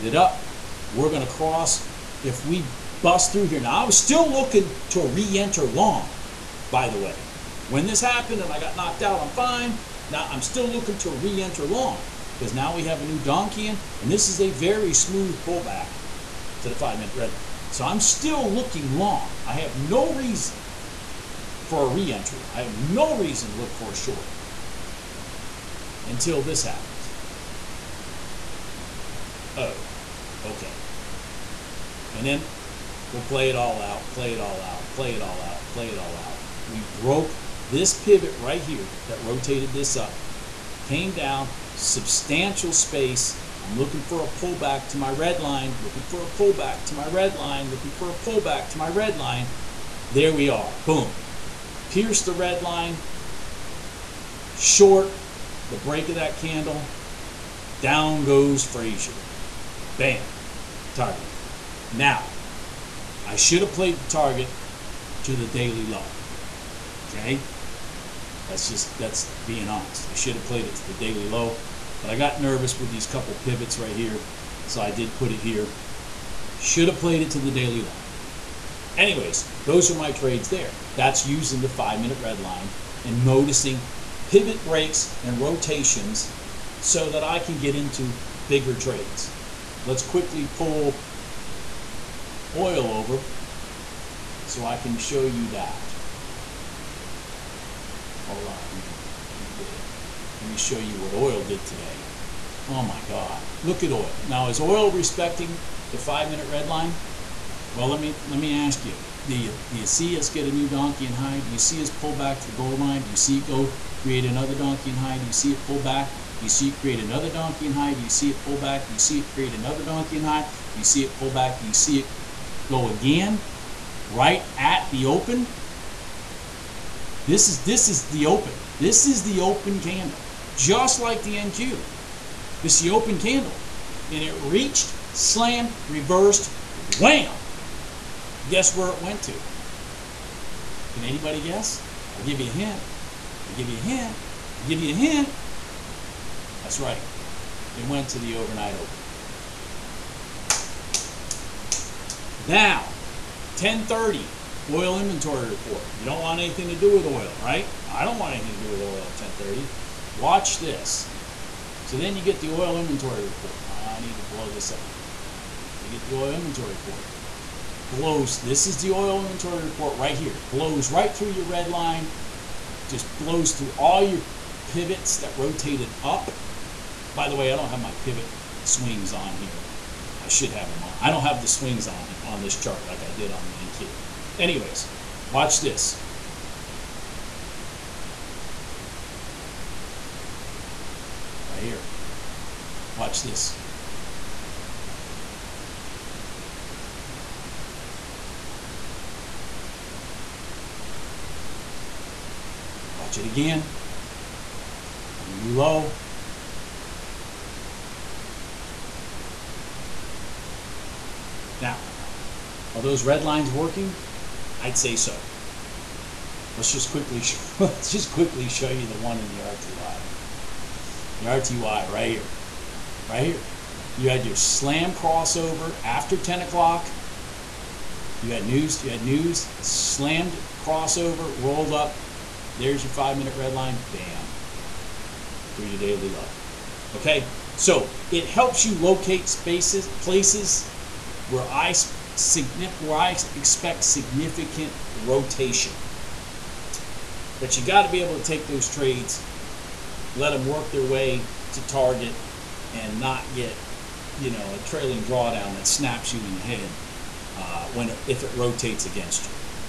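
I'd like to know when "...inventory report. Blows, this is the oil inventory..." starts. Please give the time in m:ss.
2:46.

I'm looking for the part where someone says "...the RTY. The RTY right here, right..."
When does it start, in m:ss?
3:39.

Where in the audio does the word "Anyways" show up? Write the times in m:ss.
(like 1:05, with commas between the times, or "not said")
1:18, 3:04.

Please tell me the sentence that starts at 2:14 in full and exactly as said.
And it reached, slammed, reversed, wham!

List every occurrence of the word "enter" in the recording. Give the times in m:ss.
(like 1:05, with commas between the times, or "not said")
0:05, 0:11.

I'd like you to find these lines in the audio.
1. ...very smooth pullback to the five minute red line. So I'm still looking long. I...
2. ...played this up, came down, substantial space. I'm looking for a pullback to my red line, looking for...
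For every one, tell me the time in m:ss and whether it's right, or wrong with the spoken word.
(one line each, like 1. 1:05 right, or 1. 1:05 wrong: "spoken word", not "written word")
1. 0:14 right
2. 0:39 wrong: "rotated", not "played".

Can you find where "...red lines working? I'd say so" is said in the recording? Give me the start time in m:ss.
3:33.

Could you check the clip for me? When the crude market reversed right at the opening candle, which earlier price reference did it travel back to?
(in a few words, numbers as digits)
The overnight open.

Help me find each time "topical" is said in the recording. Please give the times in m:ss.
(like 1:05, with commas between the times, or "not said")
not said.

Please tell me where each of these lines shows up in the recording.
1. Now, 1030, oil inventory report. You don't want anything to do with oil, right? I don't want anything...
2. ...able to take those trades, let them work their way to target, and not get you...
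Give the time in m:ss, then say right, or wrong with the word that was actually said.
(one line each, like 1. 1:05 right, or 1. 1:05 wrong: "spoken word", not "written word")
1. 2:32 right
2. 4:08 right.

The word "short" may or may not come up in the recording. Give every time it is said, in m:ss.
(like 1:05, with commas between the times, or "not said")
0:23, 0:54.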